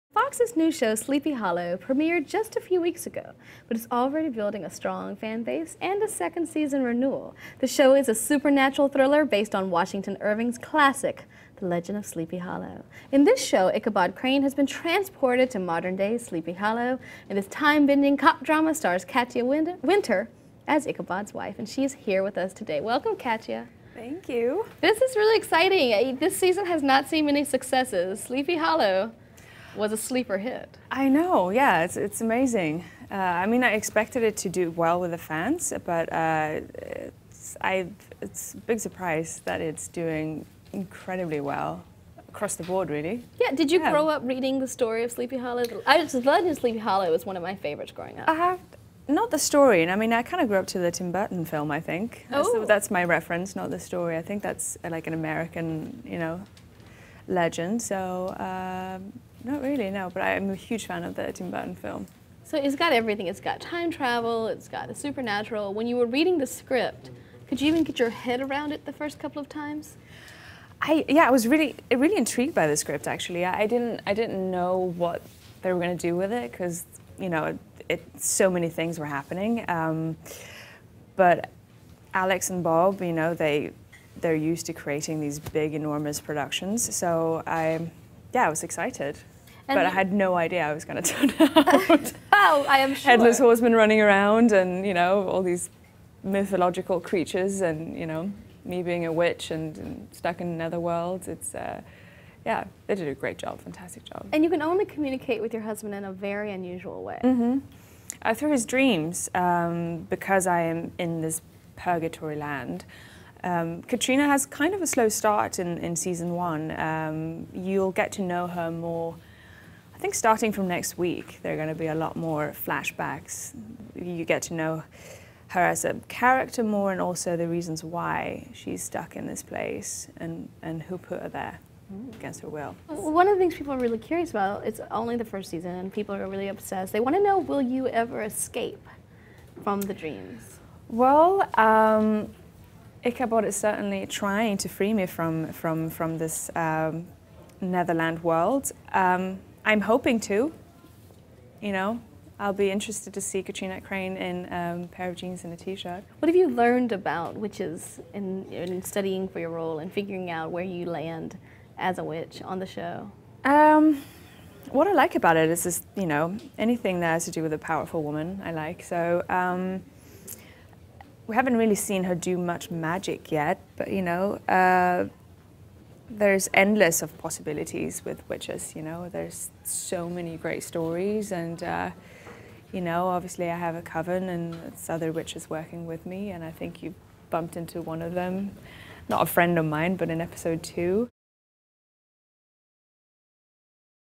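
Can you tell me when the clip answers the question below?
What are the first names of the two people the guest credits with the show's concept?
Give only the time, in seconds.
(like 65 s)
82 s.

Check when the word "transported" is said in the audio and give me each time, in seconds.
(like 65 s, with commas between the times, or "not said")
14 s.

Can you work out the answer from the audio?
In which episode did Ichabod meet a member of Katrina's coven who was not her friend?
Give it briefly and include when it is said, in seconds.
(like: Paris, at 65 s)
Episode 2, at 190 s.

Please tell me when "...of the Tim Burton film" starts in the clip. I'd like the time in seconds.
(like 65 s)
61 s.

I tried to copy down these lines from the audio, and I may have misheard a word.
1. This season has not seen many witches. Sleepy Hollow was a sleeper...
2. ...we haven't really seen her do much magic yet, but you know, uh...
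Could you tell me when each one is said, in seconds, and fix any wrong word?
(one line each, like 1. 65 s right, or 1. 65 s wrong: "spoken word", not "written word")
1. 26 s wrong: "successes", not "witches"
2. 171 s right.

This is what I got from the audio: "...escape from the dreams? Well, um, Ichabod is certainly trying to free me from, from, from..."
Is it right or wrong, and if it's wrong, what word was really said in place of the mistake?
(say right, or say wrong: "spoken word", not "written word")
right.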